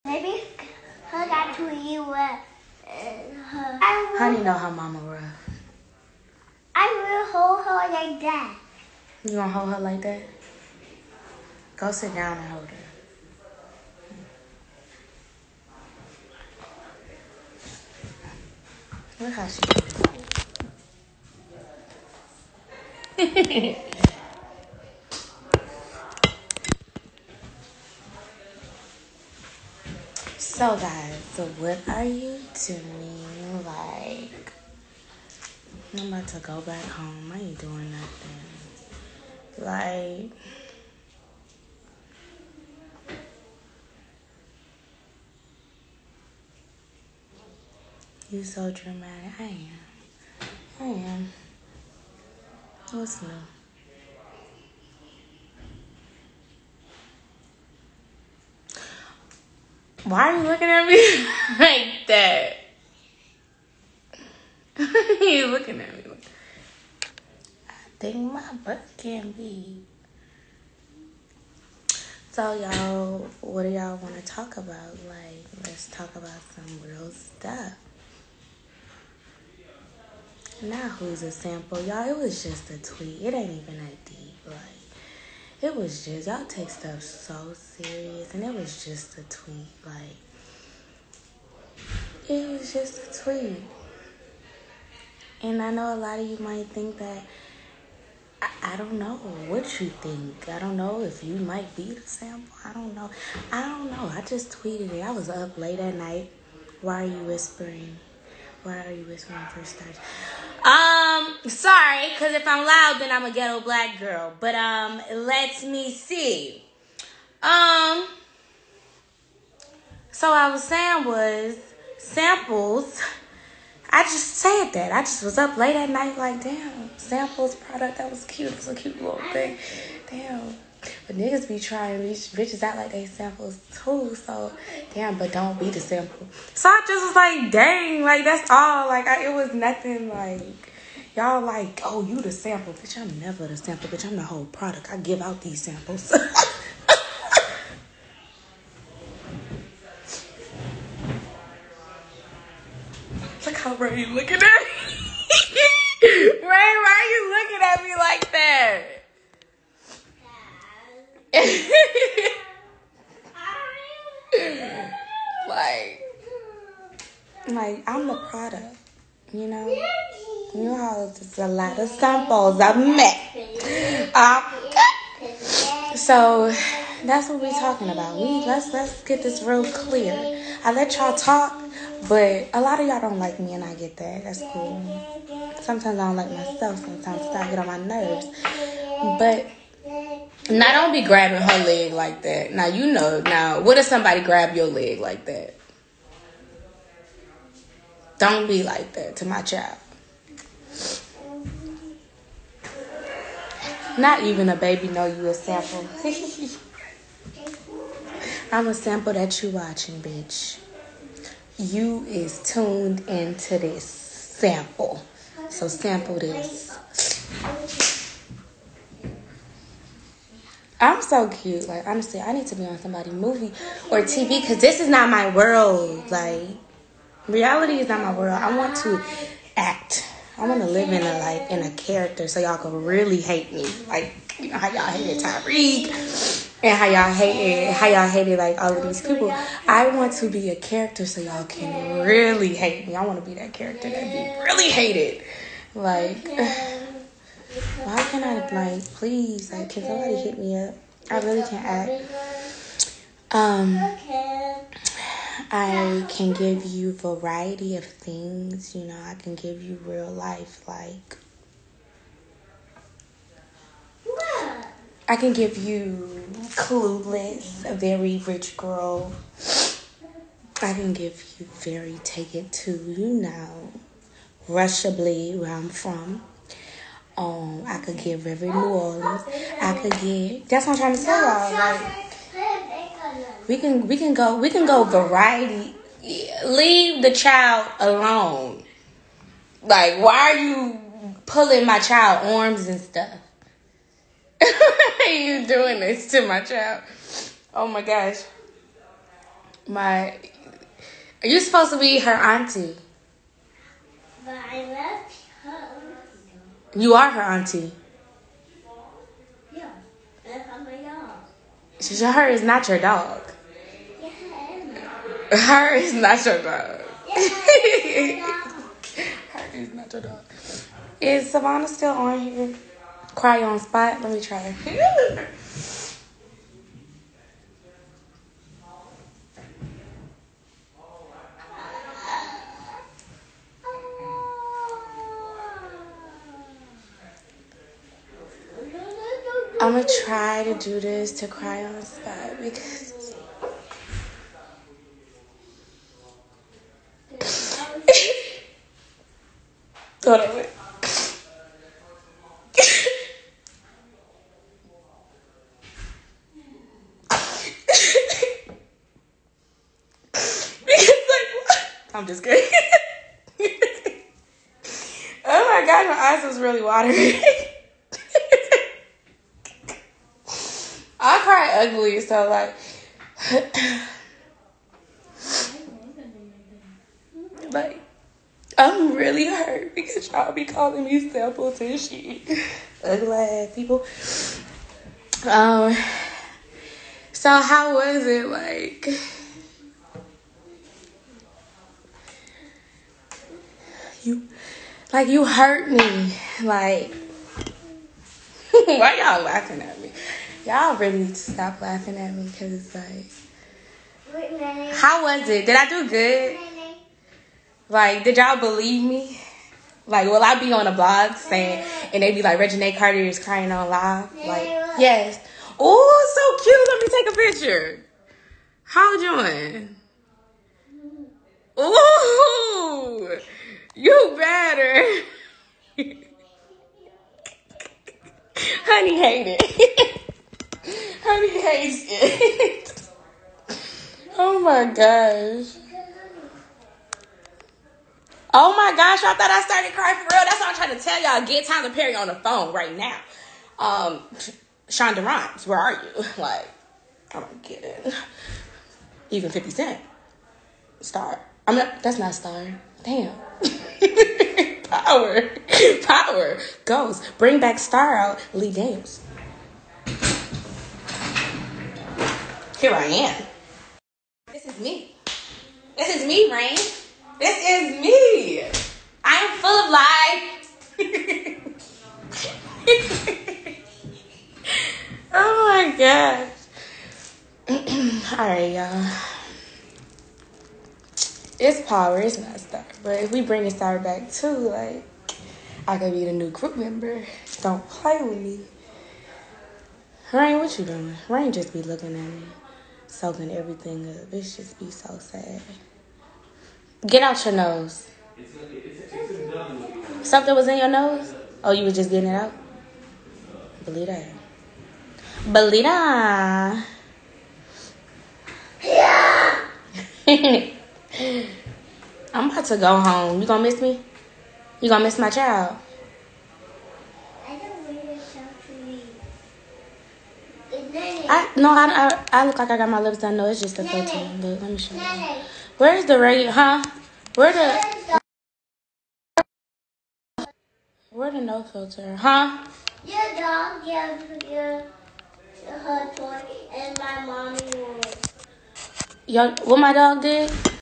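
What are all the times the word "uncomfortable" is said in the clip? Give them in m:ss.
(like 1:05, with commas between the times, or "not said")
not said.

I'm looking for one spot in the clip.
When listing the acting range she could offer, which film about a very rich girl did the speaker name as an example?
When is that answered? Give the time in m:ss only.
4:26.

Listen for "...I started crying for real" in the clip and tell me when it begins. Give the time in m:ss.
7:19.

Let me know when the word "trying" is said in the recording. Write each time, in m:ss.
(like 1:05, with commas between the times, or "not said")
2:11, 4:40, 7:20.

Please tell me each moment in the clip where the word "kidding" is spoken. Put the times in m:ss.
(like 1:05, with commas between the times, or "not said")
6:02.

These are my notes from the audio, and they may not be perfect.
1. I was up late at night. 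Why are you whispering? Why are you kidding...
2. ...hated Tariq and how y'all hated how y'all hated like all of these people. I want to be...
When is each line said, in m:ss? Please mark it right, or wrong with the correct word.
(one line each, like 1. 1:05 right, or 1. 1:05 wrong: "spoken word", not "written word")
1. 1:45 wrong: "whispering", not "kidding"
2. 3:54 right.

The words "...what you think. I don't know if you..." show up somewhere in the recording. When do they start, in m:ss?
1:39.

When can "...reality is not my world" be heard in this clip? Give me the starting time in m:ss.
3:47.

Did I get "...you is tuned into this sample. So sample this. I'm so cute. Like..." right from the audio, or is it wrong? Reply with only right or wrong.
right.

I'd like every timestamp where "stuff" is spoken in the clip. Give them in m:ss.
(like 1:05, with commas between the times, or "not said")
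1:17, 1:26, 4:52.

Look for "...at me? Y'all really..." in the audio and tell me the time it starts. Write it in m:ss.
6:39.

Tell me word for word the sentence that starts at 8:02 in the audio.
But if we bring a star back too, like I could be the new group member.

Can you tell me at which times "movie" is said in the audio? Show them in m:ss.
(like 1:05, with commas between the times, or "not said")
3:43.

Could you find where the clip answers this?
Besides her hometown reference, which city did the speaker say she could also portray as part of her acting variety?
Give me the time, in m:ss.
4:38.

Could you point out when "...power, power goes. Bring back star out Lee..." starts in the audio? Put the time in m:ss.
7:34.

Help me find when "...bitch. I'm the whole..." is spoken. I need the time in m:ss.
2:23.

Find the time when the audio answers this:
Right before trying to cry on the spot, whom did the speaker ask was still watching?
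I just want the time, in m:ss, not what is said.
5:21.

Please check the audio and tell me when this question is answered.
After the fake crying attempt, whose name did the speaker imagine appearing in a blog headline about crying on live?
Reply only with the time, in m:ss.
6:52.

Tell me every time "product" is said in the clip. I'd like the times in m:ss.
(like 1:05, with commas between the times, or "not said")
2:07, 2:24, 2:48.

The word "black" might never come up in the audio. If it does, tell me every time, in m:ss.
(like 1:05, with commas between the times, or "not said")
1:53.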